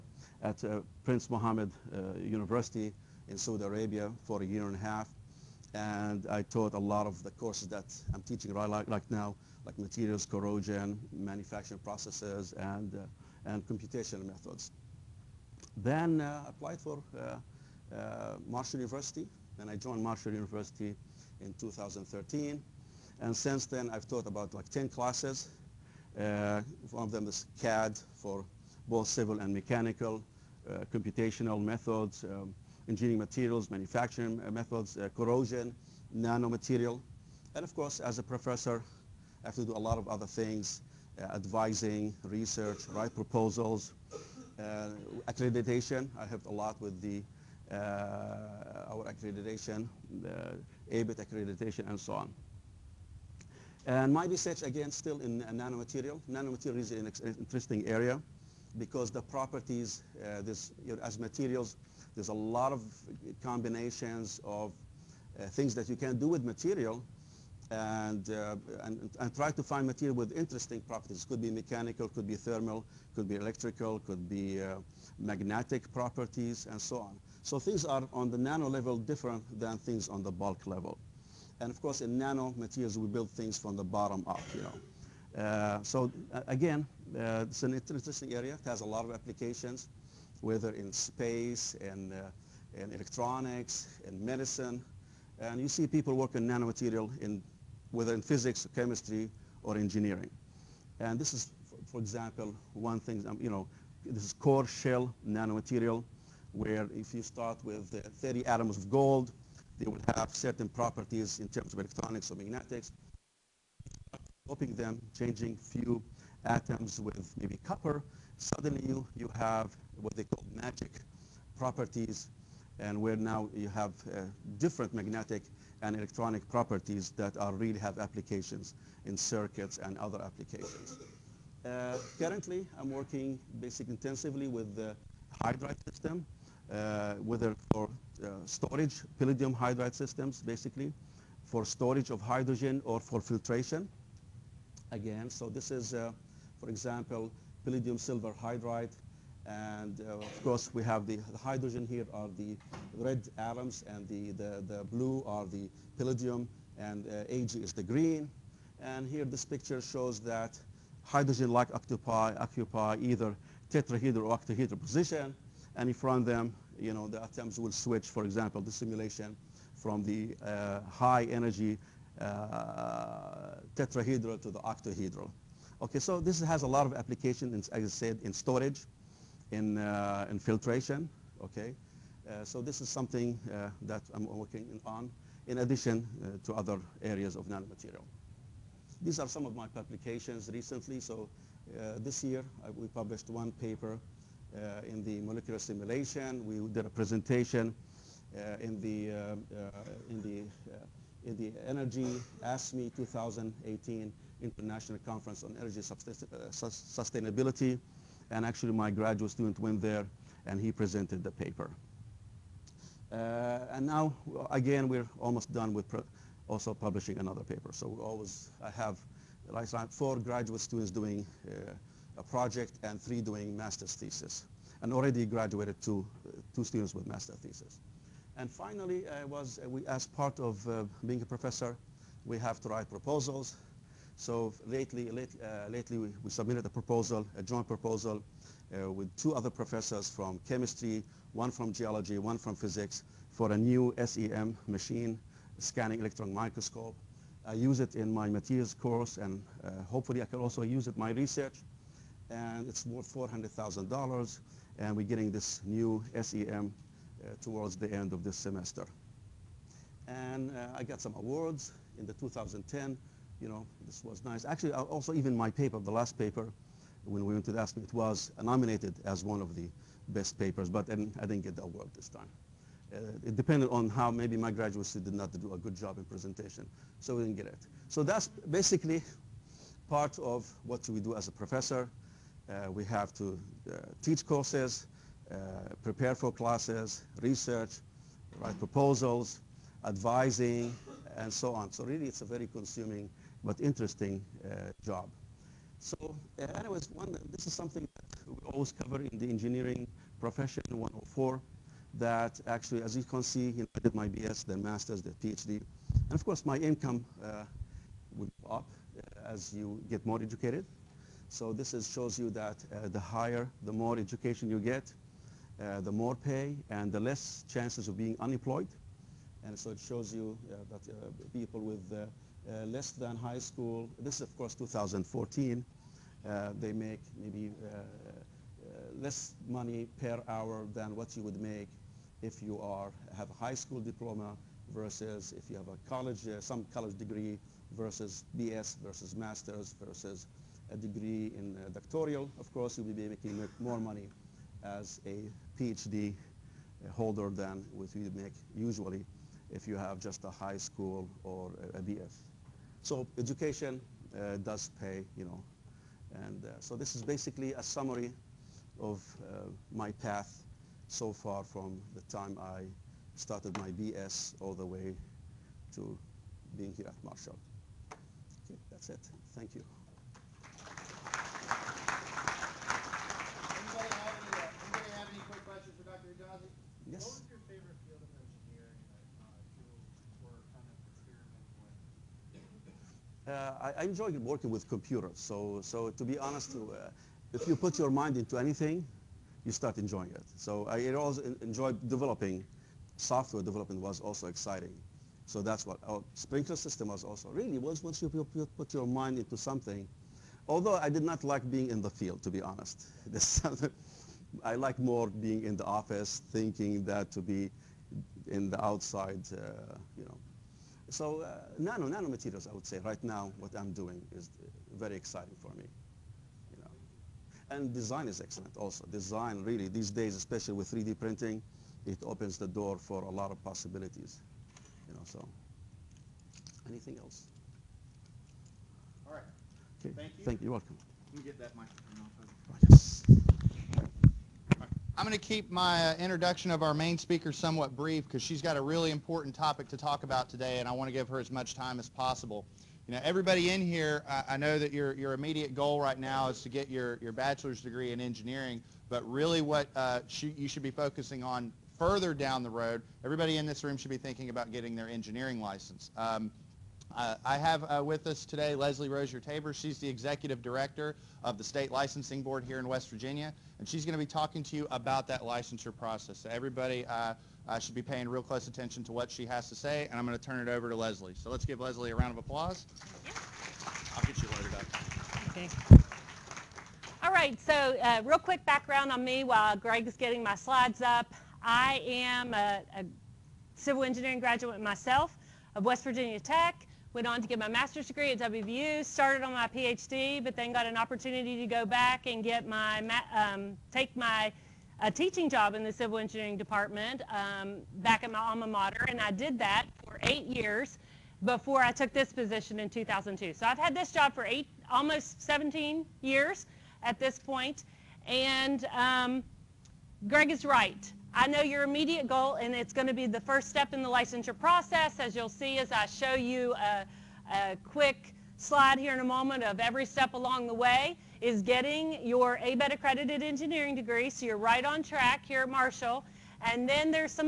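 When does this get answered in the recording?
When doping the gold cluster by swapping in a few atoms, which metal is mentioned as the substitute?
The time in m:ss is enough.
1:57.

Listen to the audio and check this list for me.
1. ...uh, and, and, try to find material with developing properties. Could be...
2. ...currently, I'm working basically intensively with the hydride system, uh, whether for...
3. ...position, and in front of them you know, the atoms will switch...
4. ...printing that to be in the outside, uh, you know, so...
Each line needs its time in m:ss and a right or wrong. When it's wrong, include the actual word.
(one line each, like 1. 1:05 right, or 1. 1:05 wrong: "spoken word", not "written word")
1. 1:08 wrong: "interesting", not "developing"
2. 2:12 right
3. 2:44 right
4. 6:46 wrong: "thinking", not "printing".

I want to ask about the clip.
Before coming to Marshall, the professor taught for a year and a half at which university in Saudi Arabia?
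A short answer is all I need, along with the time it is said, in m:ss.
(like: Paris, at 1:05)
Prince Mohammed University, at 0:01.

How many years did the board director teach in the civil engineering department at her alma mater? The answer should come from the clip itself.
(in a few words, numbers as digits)
8.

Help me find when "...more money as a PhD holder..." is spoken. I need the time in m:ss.
5:43.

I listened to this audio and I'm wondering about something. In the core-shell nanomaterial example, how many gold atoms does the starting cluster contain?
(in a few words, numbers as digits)
30.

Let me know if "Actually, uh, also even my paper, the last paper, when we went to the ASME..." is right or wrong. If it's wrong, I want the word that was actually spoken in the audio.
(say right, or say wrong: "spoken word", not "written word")
right.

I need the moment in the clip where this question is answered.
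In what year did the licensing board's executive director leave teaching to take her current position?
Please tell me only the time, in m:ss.
8:22.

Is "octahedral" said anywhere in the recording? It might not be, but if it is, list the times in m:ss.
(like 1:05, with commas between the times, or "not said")
2:44, 2:54.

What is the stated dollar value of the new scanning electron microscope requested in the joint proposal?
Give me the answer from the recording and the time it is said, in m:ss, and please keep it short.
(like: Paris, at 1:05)
$400,000, at 4:13.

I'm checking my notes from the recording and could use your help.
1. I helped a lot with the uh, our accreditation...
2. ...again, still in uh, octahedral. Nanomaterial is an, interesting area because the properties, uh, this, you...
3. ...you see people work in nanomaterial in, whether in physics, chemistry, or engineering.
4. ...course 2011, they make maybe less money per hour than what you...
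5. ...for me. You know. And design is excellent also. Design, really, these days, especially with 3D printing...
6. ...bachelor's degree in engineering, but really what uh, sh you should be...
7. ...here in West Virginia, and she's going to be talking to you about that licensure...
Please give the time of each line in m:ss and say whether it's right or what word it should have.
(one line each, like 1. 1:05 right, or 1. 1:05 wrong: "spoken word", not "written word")
1. 0:46 right
2. 0:54 wrong: "nanomaterial", not "octahedral"
3. 1:35 right
4. 5:24 wrong: "2014", not "2011"
5. 6:55 right
6. 7:27 right
7. 7:42 right.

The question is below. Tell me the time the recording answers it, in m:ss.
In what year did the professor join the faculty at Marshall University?
0:21.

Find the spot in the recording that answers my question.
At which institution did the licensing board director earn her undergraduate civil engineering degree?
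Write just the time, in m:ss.
8:05.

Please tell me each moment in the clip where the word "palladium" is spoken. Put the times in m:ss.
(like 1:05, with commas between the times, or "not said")
2:19, 2:27, 2:35.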